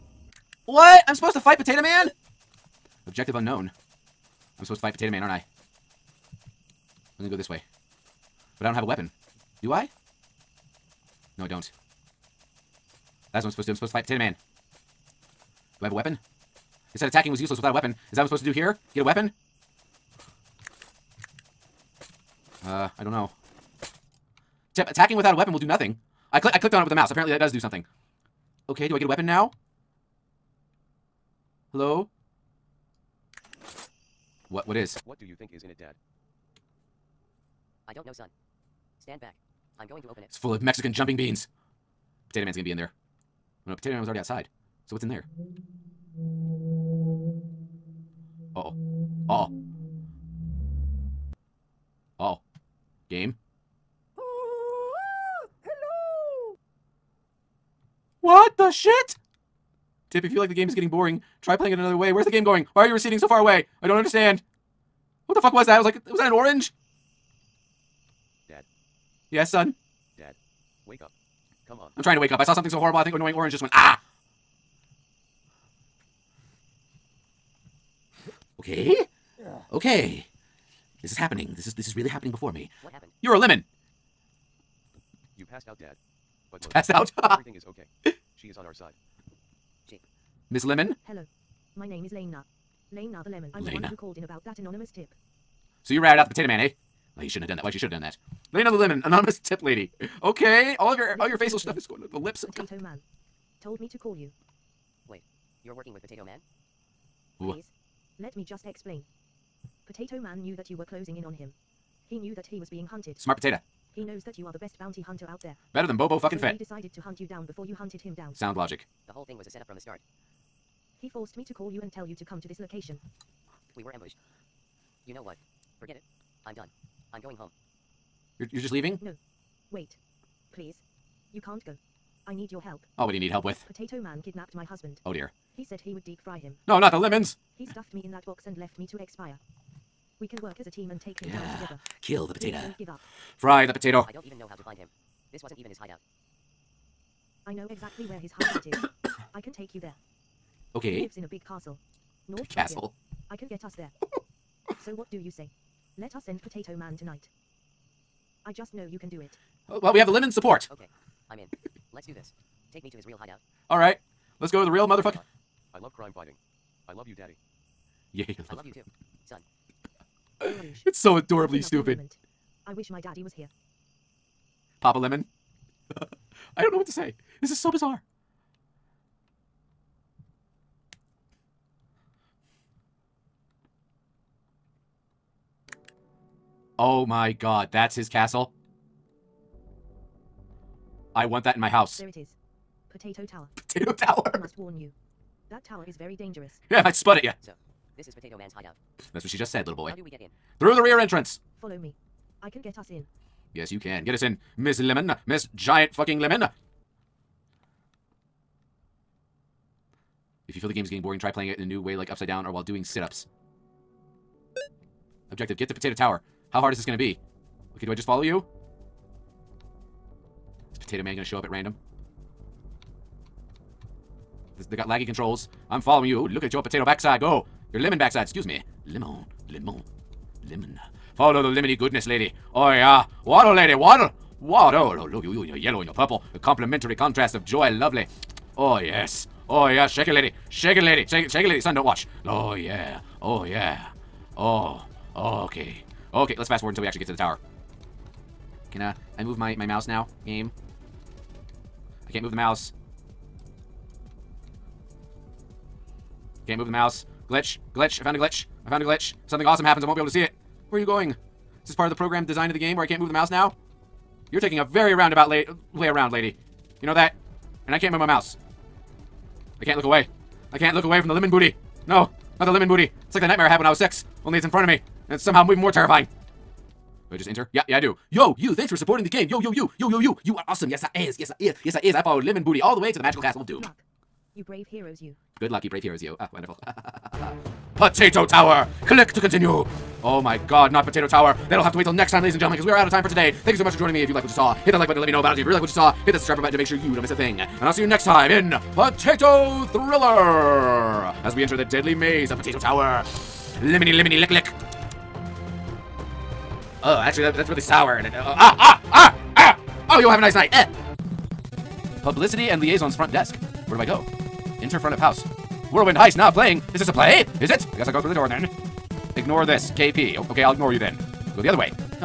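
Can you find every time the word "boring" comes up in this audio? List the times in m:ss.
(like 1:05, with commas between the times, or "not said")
1:00, 3:31.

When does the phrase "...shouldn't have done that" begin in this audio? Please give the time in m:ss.
1:37.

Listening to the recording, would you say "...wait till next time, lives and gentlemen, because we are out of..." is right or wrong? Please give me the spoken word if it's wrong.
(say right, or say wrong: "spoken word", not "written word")
wrong: "ladies", not "lives".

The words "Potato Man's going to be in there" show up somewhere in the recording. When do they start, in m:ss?
0:42.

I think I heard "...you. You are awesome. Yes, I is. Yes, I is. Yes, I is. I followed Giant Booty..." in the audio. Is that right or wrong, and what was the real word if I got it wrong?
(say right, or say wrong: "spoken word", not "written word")
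wrong: "Lemon", not "Giant".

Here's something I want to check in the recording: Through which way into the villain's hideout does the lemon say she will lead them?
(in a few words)
The rear entrance.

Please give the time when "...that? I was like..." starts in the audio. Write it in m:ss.
1:05.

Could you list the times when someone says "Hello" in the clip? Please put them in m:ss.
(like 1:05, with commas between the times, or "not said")
0:31, 1:31.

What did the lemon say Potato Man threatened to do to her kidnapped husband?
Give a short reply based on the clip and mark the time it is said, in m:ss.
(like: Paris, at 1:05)
Deep fry him, at 2:16.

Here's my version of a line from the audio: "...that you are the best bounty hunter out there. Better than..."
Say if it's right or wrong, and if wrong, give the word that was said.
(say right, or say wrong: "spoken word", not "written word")
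right.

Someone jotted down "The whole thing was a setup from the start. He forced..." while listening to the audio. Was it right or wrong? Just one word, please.
right.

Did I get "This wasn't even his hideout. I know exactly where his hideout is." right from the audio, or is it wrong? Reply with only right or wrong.
right.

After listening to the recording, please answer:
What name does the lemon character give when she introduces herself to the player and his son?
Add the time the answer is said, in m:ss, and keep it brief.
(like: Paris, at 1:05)
Lena the Lemon, at 1:32.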